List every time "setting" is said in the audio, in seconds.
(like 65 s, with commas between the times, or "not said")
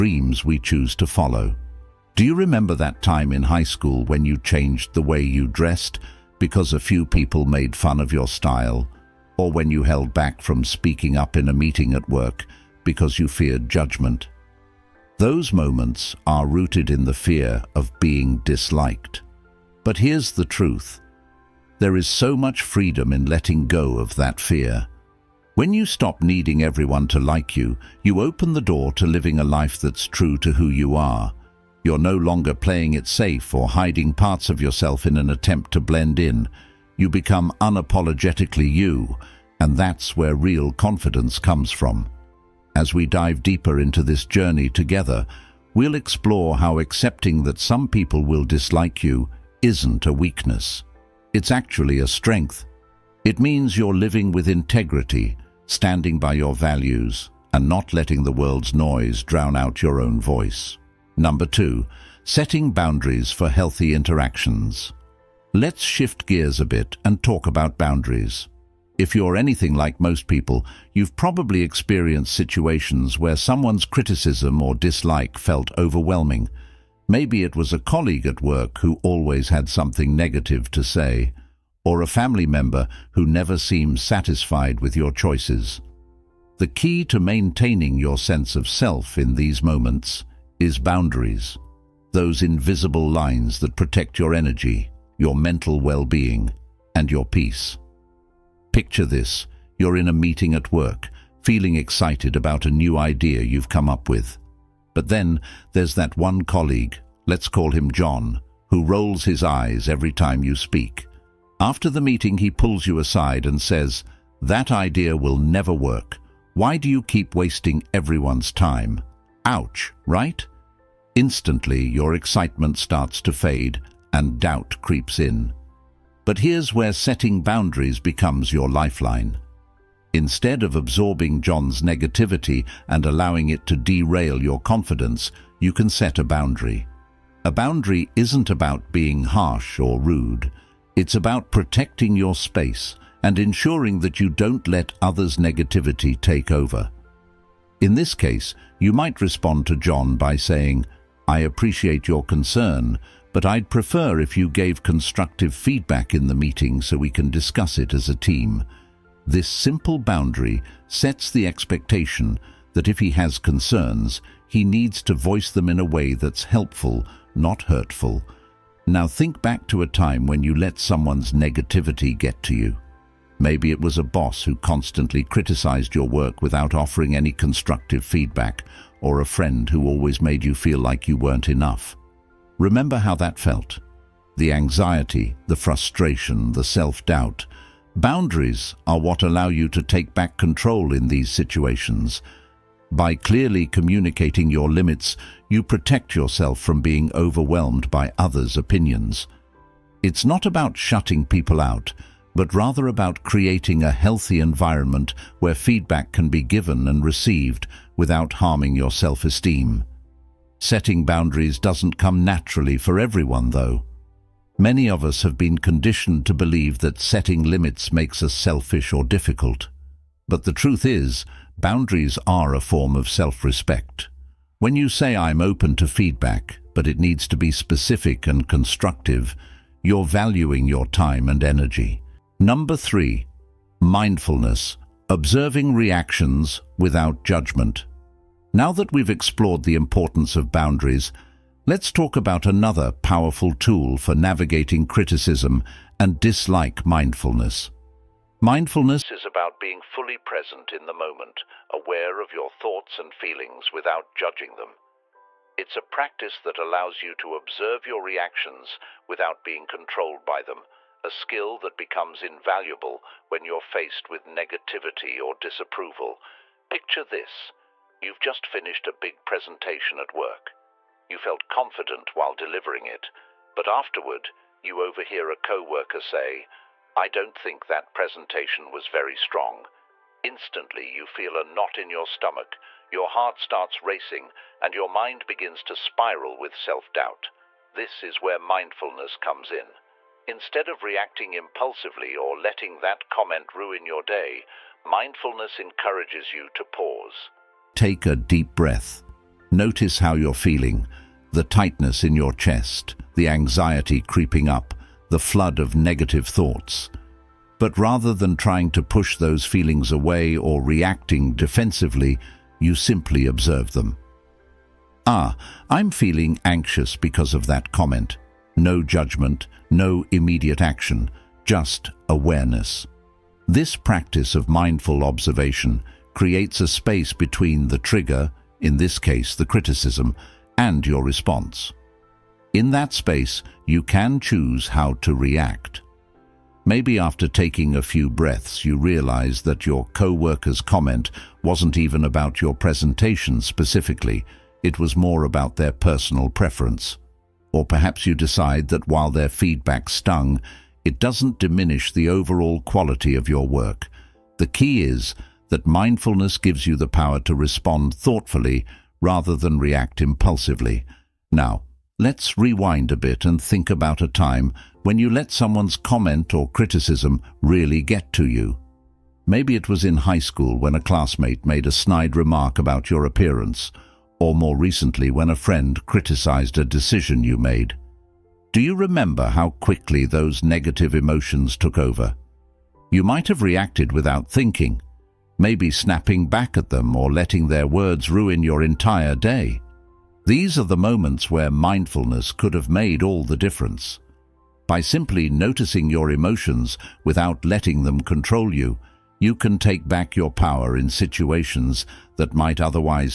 62 s, 126 s, 210 s, 216 s.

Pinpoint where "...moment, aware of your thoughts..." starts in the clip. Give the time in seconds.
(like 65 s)
250 s.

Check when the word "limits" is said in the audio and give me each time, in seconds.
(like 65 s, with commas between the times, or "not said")
194 s, 217 s.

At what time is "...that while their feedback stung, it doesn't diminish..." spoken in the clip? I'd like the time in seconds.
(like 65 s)
348 s.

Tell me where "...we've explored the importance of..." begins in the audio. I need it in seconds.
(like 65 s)
238 s.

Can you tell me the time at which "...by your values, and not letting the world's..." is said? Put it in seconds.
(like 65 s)
56 s.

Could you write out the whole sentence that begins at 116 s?
Why do you keep wasting everyone's time?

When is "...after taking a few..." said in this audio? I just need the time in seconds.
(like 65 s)
336 s.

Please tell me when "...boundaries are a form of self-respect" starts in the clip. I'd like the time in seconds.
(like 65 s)
221 s.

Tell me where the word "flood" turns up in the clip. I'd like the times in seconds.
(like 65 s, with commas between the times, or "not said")
305 s.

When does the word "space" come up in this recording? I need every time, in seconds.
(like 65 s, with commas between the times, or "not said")
142 s, 326 s, 332 s.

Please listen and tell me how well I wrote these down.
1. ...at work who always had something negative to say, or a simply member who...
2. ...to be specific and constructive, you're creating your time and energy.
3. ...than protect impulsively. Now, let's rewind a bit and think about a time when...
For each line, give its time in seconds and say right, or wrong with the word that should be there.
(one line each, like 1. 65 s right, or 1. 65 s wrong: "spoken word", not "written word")
1. 78 s wrong: "family", not "simply"
2. 227 s wrong: "valuing", not "creating"
3. 359 s wrong: "react", not "protect".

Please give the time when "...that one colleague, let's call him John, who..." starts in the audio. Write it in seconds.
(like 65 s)
105 s.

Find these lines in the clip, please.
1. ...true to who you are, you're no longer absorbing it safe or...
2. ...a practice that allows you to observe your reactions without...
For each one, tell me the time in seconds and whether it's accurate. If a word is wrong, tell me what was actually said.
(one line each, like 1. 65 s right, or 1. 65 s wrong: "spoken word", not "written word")
1. 30 s wrong: "playing", not "absorbing"
2. 255 s right.